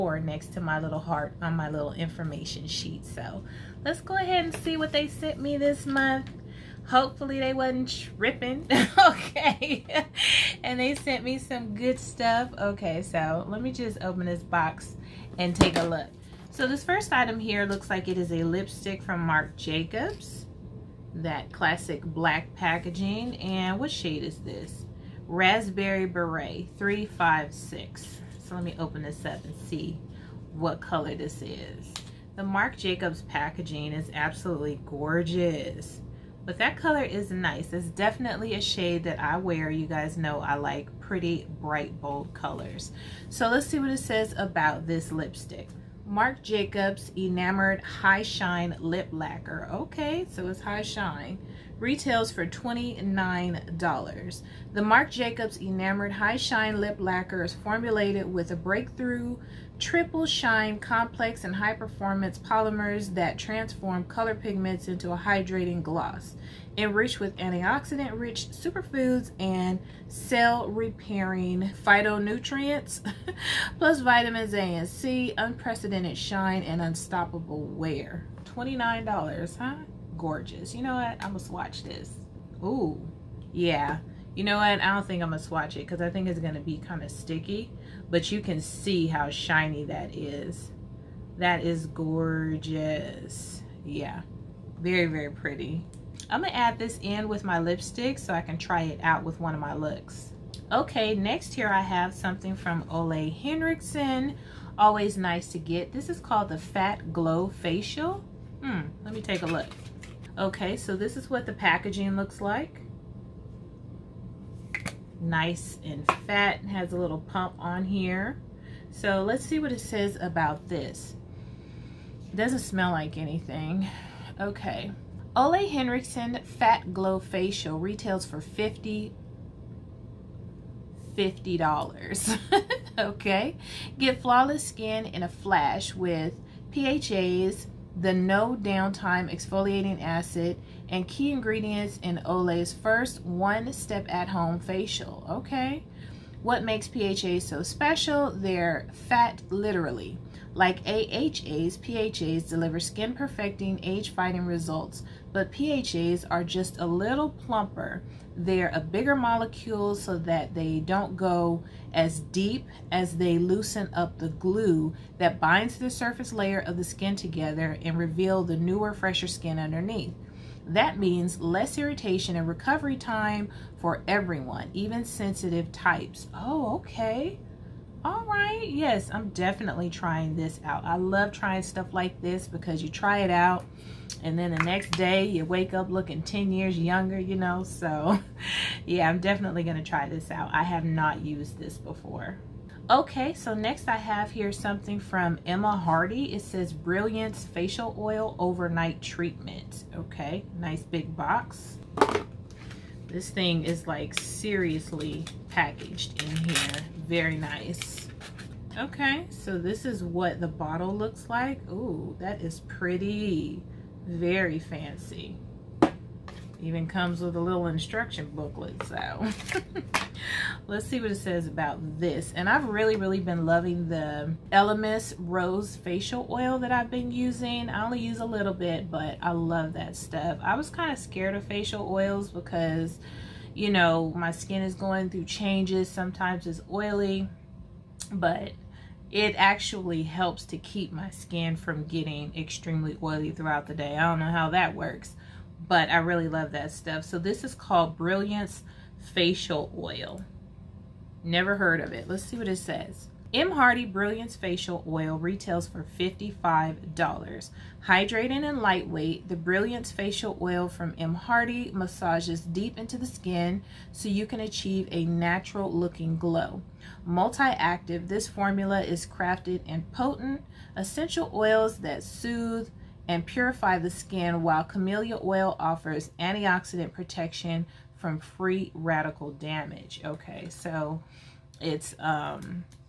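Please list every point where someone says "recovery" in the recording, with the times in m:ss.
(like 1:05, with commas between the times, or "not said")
2:52.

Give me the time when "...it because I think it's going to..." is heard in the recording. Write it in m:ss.
1:25.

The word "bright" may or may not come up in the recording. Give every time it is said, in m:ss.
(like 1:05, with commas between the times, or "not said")
0:41.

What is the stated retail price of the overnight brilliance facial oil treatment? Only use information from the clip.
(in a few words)
$55.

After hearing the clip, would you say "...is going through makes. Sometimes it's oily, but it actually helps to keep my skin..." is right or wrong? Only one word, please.
wrong.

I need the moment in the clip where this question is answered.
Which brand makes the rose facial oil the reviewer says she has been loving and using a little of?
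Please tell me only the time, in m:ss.
3:44.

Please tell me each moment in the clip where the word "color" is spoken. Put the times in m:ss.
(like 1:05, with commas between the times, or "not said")
0:30, 0:36, 0:42, 1:04.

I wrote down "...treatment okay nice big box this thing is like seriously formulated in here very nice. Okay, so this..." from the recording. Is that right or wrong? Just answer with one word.
wrong.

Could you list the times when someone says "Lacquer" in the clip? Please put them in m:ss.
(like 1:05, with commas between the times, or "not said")
0:49, 0:56.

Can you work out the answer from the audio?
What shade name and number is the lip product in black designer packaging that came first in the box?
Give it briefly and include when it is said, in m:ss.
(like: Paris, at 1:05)
Raspberry Beret 356, at 0:25.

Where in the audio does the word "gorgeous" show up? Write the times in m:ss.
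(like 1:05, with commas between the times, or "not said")
0:34, 1:20, 1:31.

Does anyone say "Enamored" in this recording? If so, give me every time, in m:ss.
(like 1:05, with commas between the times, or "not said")
0:47, 0:55.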